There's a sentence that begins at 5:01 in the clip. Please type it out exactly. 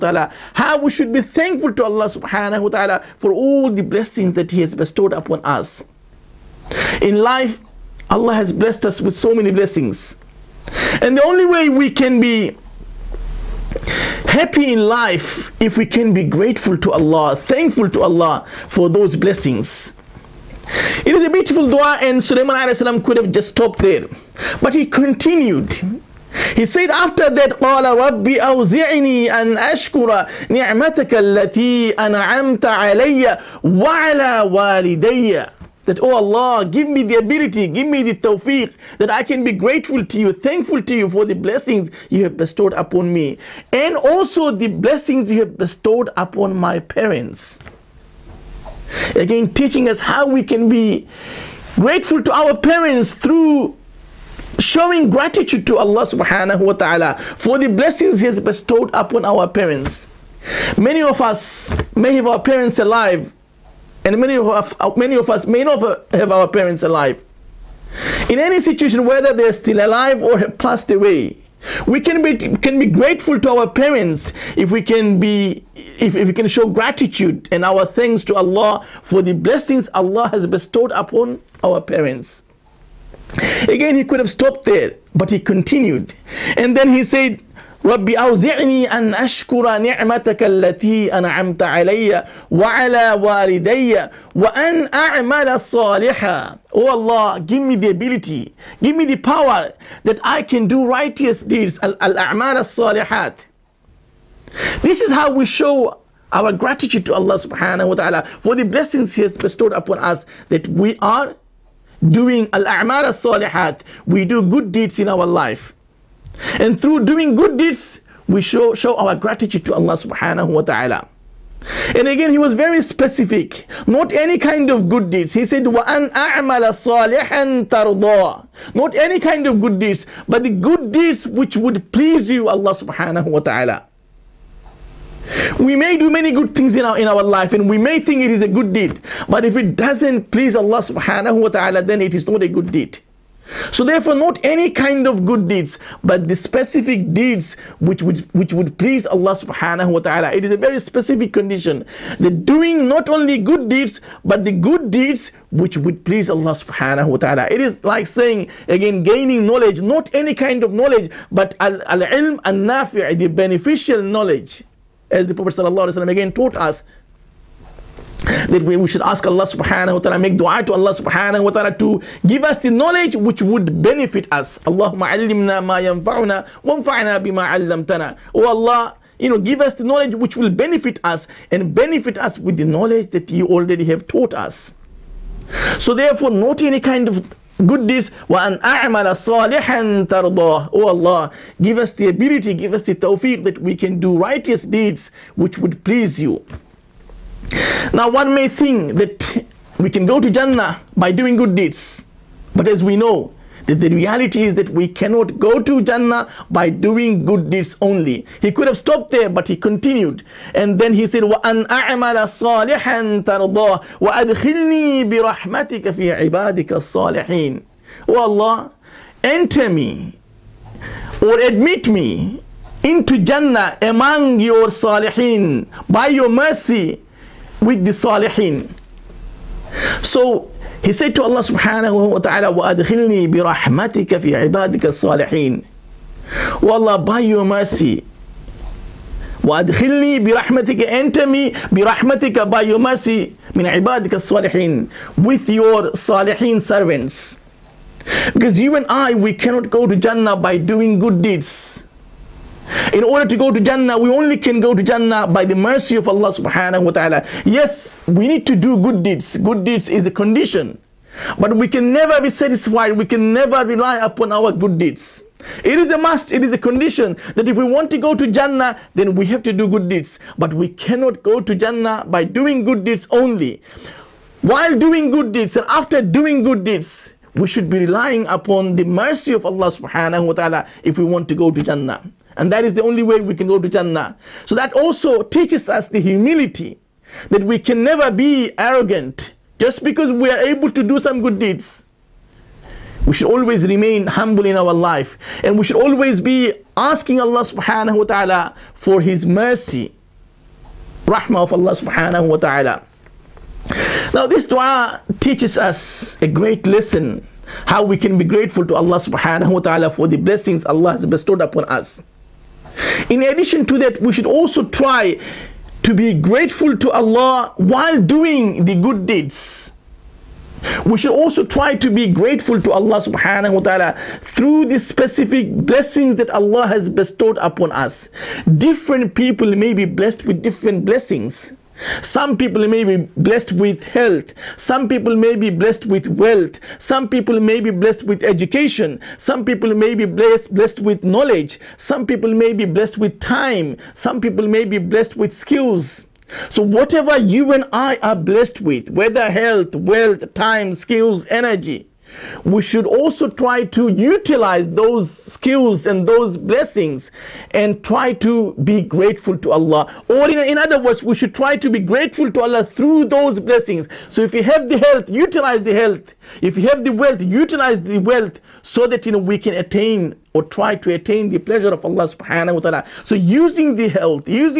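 Rahmah of Allah subhanahu wa ta'ala.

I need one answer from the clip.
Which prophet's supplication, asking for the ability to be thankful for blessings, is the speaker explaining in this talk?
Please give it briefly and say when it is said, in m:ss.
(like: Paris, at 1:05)
Sulaiman, at 0:22.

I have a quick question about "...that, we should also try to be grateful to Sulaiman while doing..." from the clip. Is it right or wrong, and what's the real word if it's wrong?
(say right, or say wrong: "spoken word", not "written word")
wrong: "Allah", not "Sulaiman".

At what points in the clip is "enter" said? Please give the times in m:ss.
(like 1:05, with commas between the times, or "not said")
3:39, 4:00.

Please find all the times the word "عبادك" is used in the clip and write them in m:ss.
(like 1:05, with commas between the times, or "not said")
3:36, 3:54, 4:03.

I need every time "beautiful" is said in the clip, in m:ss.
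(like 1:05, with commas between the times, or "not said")
0:21.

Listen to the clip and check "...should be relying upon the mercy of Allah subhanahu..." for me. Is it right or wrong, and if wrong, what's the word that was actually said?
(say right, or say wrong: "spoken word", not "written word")
right.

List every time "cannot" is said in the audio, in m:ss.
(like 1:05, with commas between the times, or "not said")
3:24, 4:09, 4:30.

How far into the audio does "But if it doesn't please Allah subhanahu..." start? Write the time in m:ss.
2:19.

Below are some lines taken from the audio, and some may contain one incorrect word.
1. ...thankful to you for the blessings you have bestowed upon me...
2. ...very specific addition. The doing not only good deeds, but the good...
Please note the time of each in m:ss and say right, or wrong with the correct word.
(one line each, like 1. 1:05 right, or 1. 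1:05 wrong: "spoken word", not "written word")
1. 0:40 right
2. 2:30 wrong: "condition", not "addition".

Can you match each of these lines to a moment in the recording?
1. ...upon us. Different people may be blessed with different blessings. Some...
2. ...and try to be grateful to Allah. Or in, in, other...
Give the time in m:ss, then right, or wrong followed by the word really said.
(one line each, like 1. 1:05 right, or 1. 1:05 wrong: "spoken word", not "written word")
1. 5:27 right
2. 5:57 right.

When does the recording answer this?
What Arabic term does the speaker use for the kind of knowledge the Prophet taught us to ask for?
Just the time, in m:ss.
2:41.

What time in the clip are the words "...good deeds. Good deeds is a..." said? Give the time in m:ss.
4:18.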